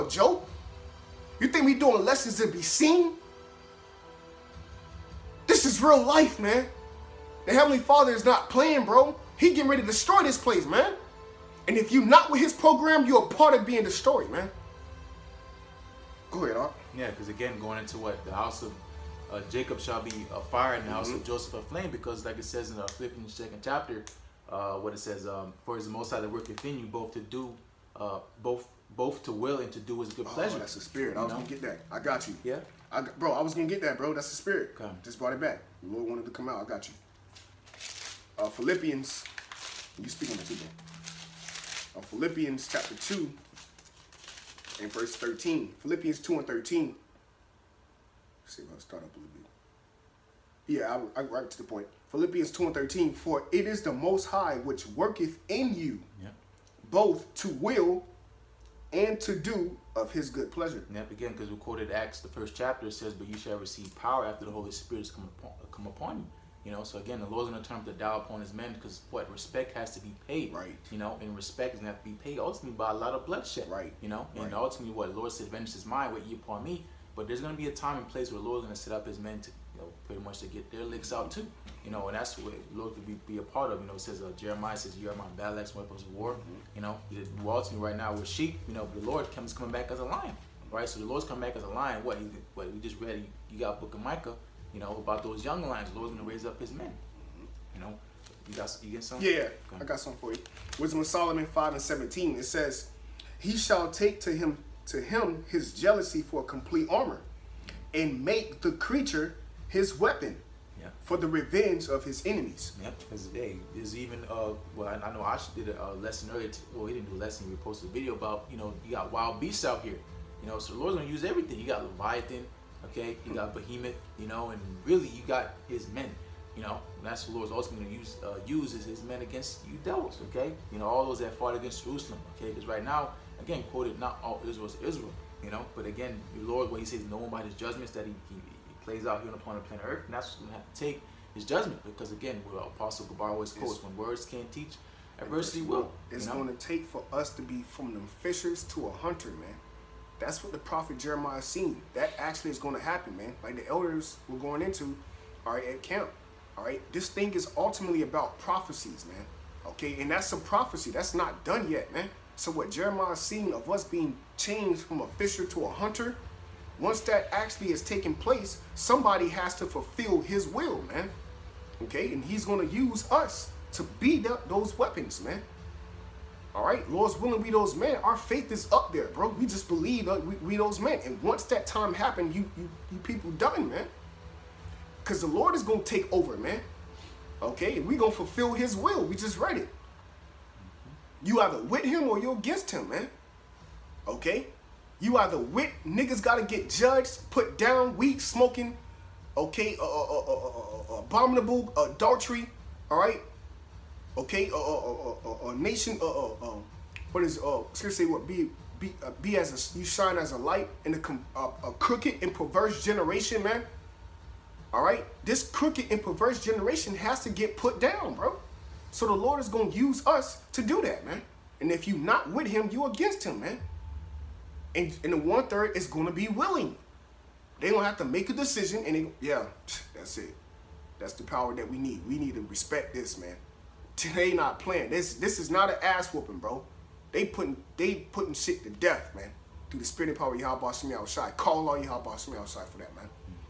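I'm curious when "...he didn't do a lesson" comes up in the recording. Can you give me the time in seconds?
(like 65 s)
116 s.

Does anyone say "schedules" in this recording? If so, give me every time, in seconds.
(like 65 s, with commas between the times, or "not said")
not said.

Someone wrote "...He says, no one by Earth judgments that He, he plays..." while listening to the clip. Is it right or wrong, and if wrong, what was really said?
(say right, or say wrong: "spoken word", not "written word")
wrong: "His", not "Earth".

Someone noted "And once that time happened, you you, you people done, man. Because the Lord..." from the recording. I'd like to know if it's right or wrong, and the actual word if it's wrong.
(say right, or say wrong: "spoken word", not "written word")
right.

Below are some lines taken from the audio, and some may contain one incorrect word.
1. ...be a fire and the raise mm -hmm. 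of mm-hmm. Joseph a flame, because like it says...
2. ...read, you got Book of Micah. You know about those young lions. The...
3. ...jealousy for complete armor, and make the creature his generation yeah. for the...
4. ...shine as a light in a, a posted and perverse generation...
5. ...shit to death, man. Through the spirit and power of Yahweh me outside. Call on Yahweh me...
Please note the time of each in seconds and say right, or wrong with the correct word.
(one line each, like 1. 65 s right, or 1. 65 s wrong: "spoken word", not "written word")
1. 20 s wrong: "house", not "raise"
2. 93 s right
3. 105 s wrong: "weapon", not "generation"
4. 209 s wrong: "crooked", not "posted"
5. 238 s right.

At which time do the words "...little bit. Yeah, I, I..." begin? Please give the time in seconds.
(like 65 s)
49 s.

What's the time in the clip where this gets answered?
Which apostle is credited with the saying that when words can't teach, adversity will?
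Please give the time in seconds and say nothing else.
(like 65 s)
142 s.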